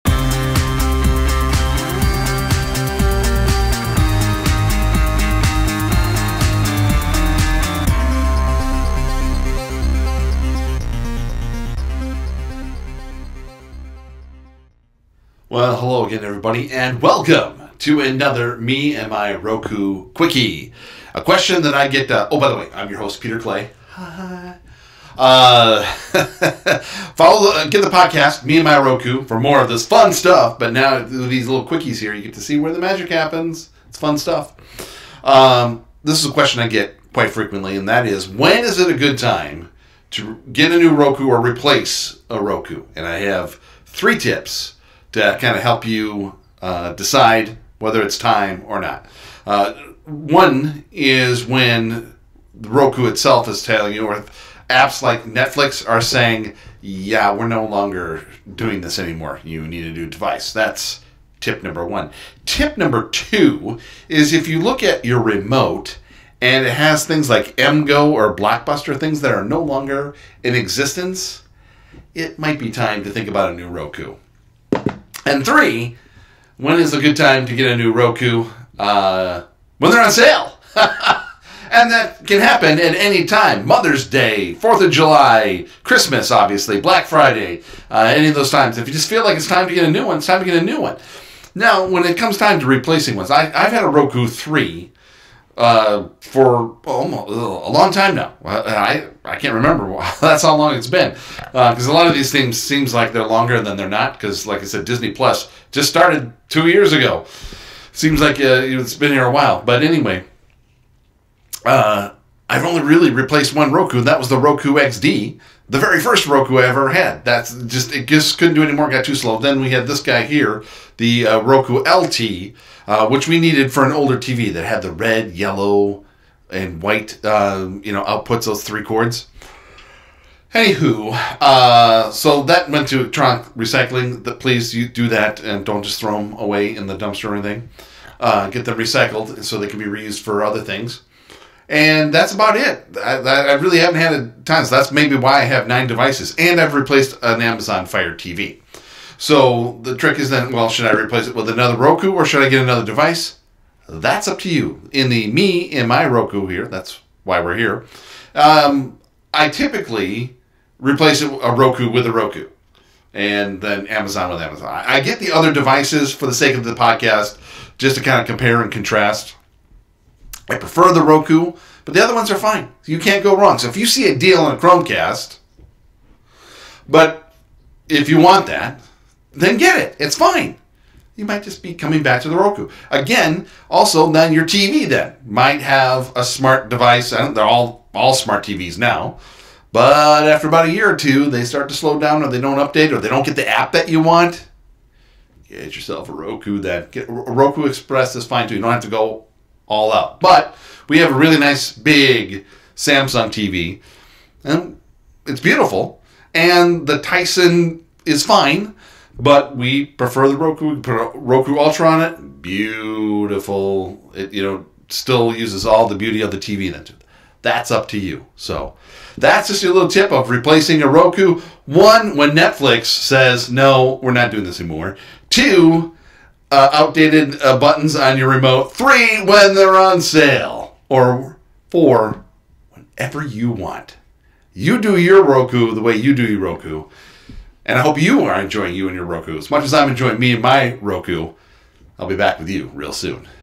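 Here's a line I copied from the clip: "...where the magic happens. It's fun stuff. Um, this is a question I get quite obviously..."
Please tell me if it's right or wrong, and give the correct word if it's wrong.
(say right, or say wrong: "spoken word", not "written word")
wrong: "frequently", not "obviously".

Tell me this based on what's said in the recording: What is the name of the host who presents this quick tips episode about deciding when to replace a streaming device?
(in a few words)
Peter Clay.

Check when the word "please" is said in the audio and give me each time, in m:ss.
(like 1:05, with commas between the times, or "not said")
2:14.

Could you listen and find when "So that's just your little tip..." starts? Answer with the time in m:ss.
3:38.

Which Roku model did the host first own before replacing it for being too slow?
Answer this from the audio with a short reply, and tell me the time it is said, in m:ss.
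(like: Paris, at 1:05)
Roku XD, at 1:54.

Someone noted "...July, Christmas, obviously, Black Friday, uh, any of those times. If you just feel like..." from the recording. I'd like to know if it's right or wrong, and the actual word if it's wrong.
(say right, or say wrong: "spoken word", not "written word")
right.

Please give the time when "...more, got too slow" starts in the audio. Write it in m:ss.
1:58.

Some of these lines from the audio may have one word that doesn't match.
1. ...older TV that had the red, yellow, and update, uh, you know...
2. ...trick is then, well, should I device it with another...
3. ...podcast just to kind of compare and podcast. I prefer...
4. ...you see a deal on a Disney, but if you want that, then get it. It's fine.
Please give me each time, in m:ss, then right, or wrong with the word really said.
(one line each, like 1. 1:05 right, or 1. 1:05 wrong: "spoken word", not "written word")
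1. 2:03 wrong: "white", not "update"
2. 2:29 wrong: "replace", not "device"
3. 2:46 wrong: "contrast", not "podcast"
4. 2:53 wrong: "Chromecast", not "Disney".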